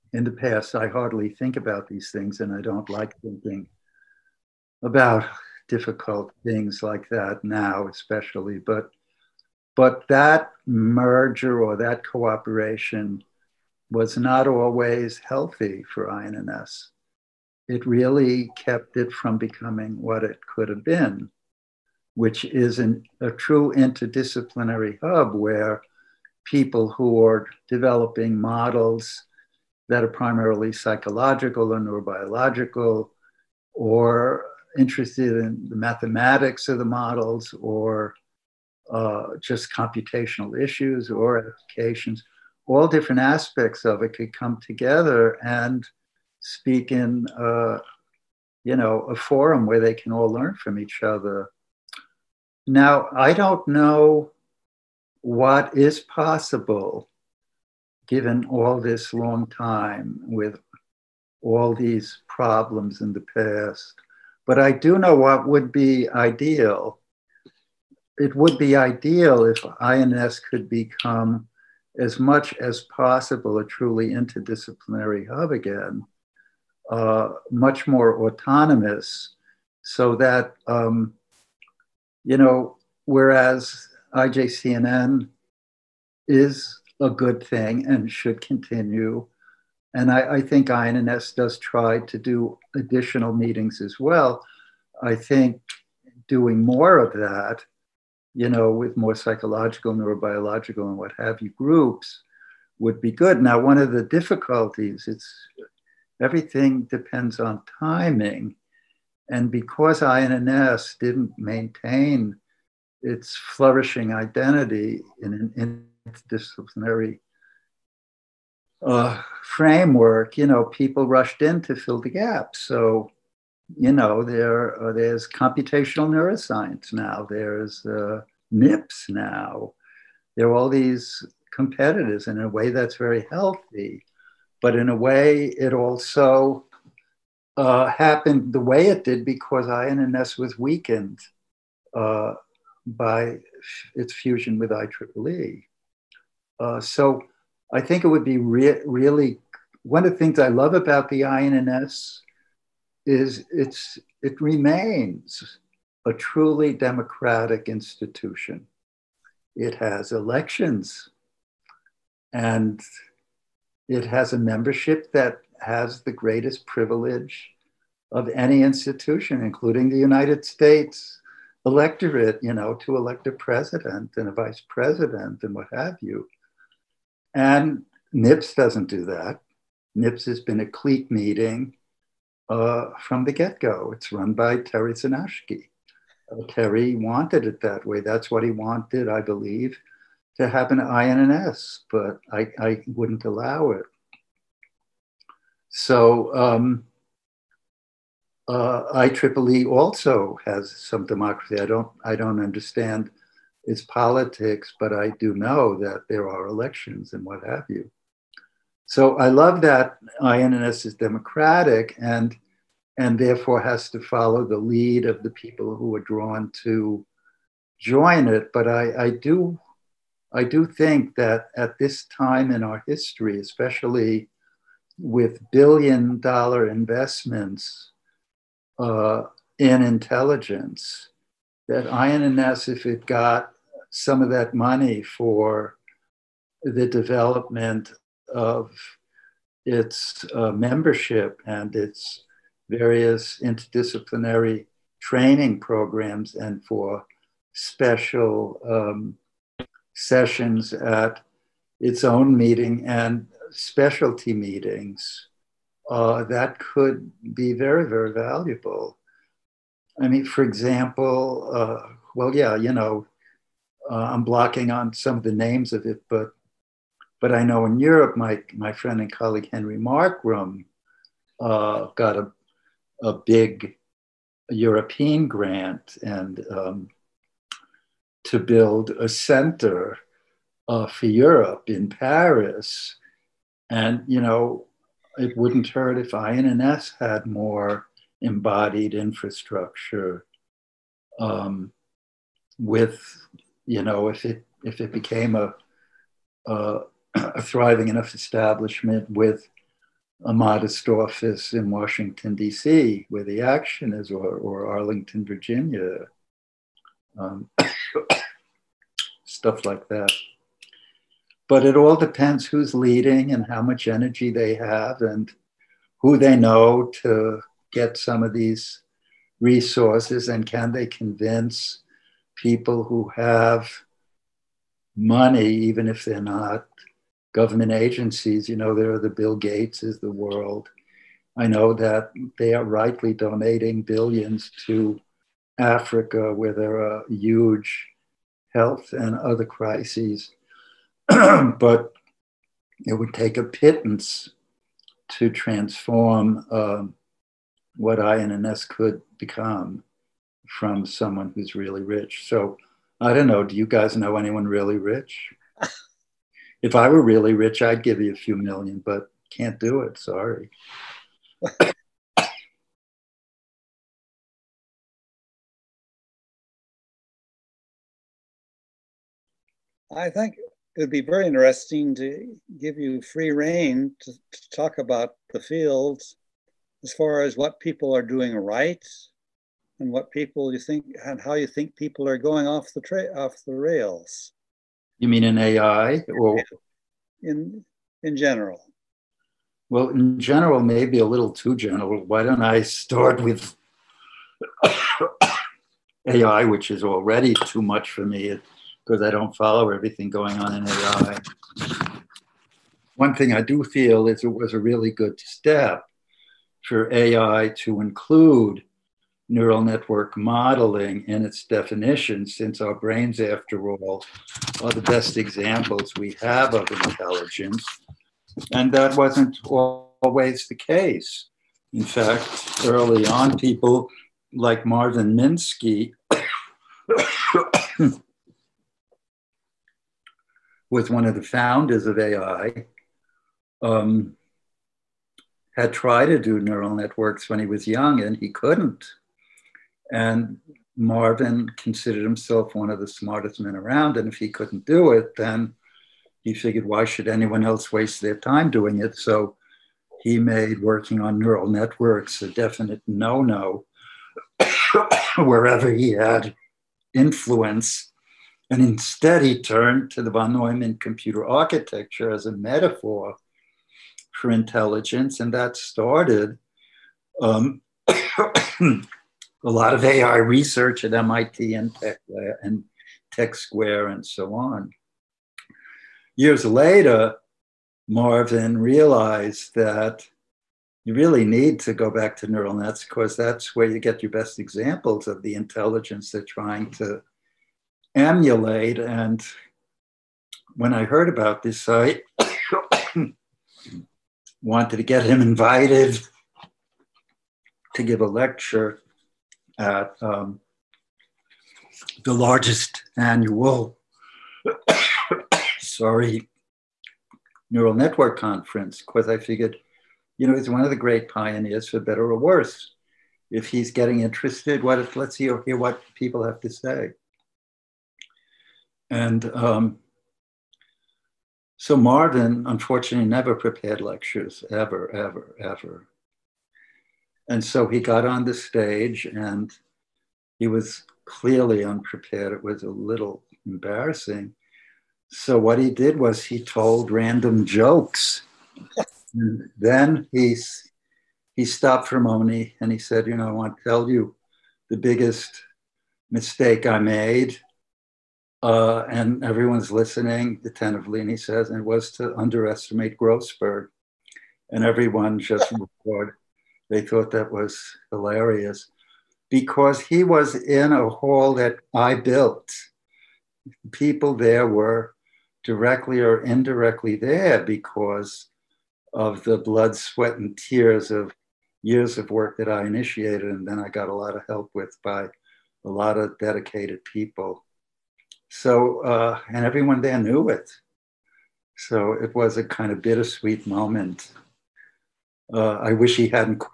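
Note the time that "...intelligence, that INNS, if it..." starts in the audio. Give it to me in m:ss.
3:49.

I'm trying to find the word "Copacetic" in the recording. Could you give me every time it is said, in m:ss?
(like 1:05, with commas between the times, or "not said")
not said.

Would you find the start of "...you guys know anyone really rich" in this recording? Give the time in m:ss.
5:53.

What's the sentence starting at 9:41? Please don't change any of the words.
So it was a kind of bittersweet moment.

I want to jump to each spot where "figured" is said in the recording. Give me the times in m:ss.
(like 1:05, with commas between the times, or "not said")
7:26, 8:29.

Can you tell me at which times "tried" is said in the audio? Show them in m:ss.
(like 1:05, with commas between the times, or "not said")
7:15.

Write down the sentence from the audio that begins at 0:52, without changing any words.
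Now, I don't know what is possible given all this long time with all these problems in the past.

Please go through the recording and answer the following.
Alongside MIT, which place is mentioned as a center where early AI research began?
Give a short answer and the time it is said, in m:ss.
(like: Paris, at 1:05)
Tech Square, at 7:53.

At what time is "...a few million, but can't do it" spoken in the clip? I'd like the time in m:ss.
5:58.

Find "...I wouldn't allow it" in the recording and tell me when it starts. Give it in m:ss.
3:12.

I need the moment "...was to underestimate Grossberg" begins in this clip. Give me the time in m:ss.
9:11.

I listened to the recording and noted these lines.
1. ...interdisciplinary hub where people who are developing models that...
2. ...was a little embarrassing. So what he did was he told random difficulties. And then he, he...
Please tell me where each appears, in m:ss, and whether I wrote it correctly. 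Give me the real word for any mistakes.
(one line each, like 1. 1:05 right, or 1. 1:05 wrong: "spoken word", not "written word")
1. 0:23 right
2. 8:52 wrong: "jokes", not "difficulties".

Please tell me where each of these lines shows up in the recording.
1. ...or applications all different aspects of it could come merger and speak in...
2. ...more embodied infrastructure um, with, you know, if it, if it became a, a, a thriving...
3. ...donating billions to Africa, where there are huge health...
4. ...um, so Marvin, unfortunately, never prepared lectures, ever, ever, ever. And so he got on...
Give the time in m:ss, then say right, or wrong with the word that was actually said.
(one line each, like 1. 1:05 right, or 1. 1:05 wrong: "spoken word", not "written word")
1. 0:41 wrong: "together", not "merger"
2. 4:47 right
3. 5:33 right
4. 8:39 right.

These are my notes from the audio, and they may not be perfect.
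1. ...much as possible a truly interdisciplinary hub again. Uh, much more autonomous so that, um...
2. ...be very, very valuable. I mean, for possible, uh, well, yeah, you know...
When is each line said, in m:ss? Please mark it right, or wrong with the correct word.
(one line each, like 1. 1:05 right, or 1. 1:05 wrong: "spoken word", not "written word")
1. 1:12 right
2. 4:17 wrong: "example", not "possible".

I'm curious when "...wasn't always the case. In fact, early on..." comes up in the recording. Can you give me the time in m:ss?
6:58.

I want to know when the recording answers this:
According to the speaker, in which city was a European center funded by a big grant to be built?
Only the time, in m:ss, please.
4:41.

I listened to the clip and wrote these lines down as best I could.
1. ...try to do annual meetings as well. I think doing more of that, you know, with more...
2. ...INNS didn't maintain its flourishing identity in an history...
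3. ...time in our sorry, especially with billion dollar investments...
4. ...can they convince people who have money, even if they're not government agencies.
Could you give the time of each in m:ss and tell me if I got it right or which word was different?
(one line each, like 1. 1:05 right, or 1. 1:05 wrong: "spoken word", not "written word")
1. 1:31 wrong: "additional", not "annual"
2. 1:50 wrong: "interdisciplinary", not "history"
3. 3:42 wrong: "history", not "sorry"
4. 5:20 right.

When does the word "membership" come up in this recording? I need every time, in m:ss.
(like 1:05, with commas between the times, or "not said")
2:44, 4:00.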